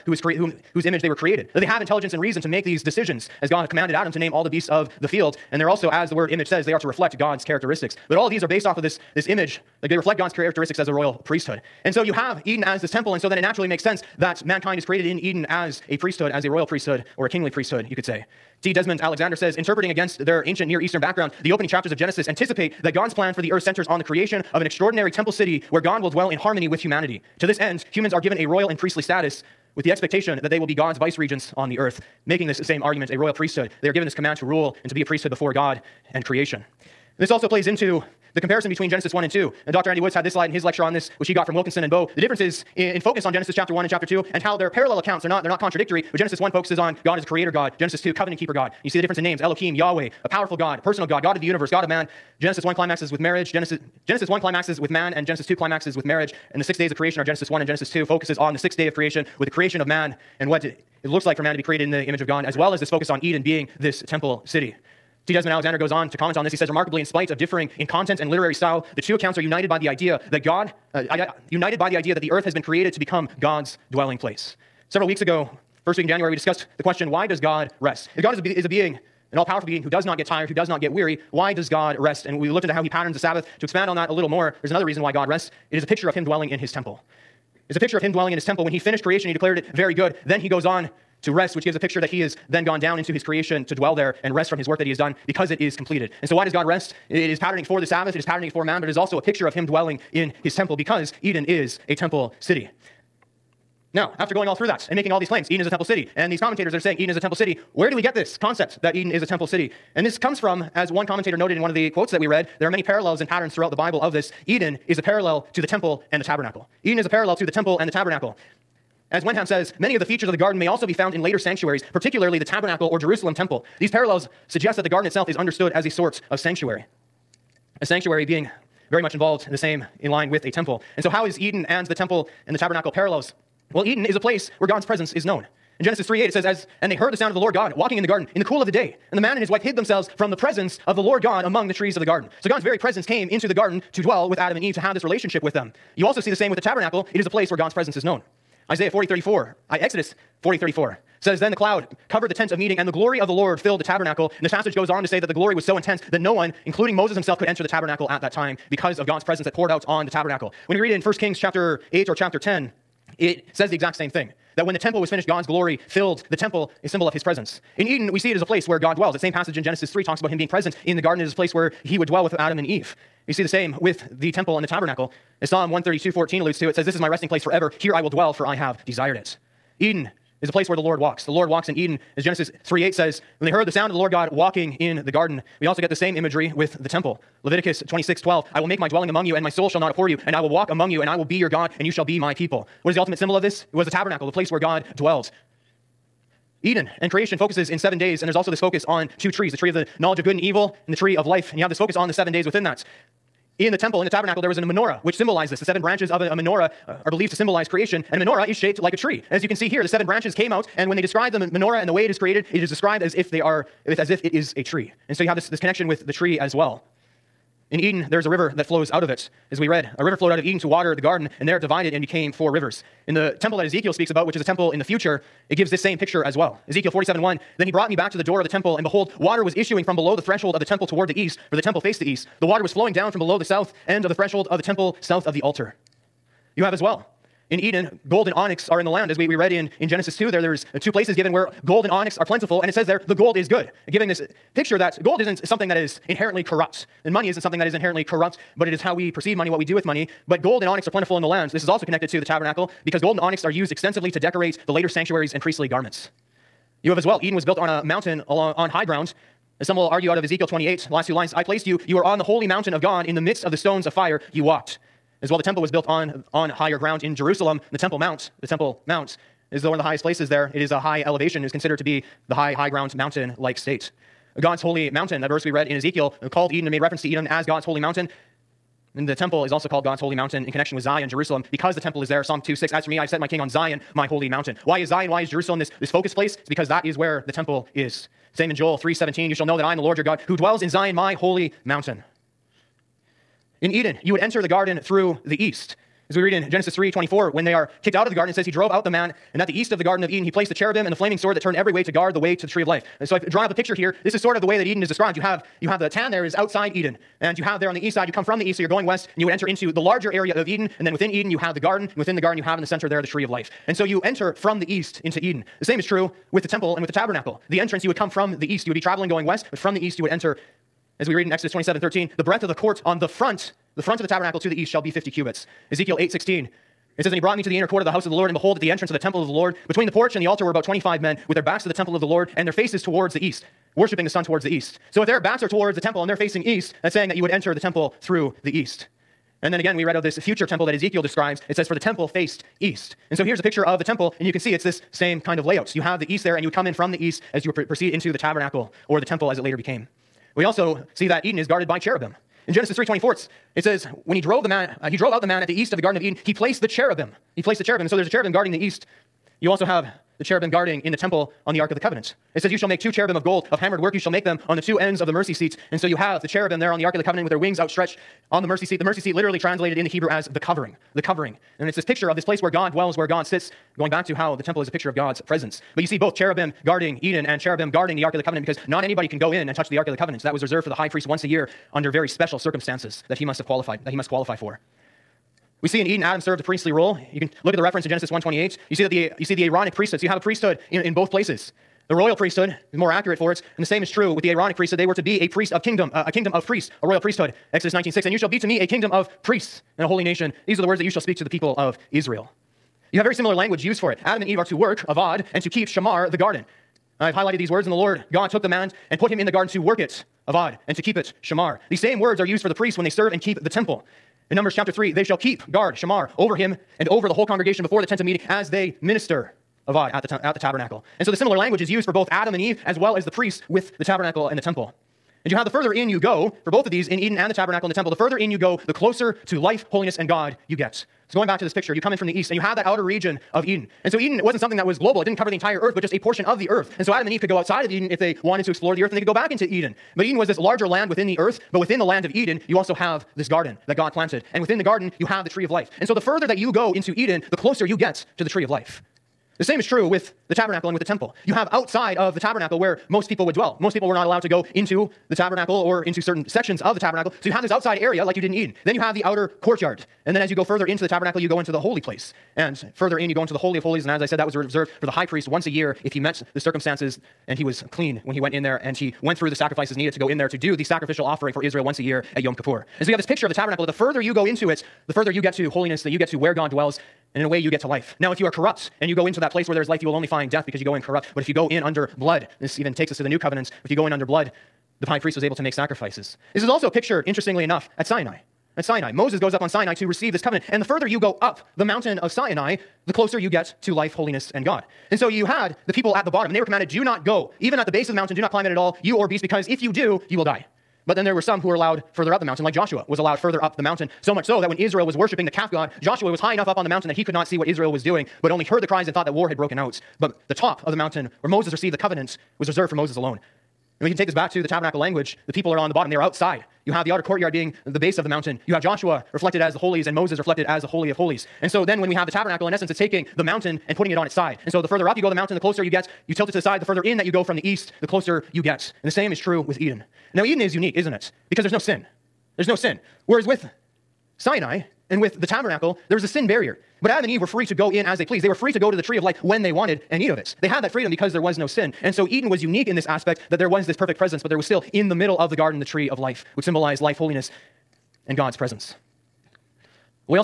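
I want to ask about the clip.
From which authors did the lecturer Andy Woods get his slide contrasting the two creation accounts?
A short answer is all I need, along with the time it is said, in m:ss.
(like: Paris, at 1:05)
Wilkinson and Boa, at 0:41.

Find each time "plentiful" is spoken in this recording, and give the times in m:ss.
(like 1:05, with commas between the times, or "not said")
4:02, 4:10.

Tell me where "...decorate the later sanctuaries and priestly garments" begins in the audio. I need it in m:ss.
4:14.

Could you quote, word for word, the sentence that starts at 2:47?
In Eden, we see it as a place where God dwells.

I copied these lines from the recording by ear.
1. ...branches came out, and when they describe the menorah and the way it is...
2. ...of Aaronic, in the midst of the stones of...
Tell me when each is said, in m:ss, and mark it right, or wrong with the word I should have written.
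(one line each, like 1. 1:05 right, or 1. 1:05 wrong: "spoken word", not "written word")
1. 3:30 right
2. 4:22 wrong: "God", not "Aaronic".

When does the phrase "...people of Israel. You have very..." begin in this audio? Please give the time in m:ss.
6:41.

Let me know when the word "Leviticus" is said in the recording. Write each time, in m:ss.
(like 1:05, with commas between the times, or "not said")
3:07.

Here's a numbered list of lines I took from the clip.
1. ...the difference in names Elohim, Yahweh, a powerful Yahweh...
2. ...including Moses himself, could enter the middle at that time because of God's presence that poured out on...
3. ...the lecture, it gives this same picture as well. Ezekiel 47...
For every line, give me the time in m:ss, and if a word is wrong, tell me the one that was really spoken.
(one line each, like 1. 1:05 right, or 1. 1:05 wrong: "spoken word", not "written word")
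1. 0:48 wrong: "God", not "Yahweh"
2. 2:36 wrong: "tabernacle", not "middle"
3. 3:44 wrong: "future", not "lecture".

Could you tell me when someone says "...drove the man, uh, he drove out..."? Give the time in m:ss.
5:54.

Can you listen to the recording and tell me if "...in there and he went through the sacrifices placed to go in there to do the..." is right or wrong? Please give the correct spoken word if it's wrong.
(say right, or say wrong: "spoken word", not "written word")
wrong: "needed", not "placed".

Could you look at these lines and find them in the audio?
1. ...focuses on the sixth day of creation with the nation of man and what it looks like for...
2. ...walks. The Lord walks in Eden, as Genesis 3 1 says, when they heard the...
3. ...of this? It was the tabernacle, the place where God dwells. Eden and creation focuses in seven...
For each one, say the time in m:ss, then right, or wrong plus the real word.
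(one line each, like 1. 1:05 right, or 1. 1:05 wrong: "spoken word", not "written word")
1. 0:58 wrong: "creation", not "nation"
2. 3:00 wrong: "8", not "1"
3. 3:13 right.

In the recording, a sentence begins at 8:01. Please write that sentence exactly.
But if you go in under blood, this even takes us to the new covenants.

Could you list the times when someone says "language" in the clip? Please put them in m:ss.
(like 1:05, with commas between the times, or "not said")
6:43, 7:01, 8:34.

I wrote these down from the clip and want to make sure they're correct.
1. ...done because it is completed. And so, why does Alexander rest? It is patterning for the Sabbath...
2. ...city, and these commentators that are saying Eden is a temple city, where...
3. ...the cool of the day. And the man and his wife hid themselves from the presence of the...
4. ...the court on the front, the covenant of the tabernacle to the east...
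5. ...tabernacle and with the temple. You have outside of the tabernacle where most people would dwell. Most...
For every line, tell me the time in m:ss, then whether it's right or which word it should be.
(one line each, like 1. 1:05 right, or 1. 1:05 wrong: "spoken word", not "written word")
1. 1:34 wrong: "God", not "Alexander"
2. 1:45 right
3. 2:18 right
4. 5:22 wrong: "front", not "covenant"
5. 7:30 right.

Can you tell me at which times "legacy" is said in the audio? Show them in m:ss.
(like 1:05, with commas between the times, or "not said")
not said.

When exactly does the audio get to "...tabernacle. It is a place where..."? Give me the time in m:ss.
2:26.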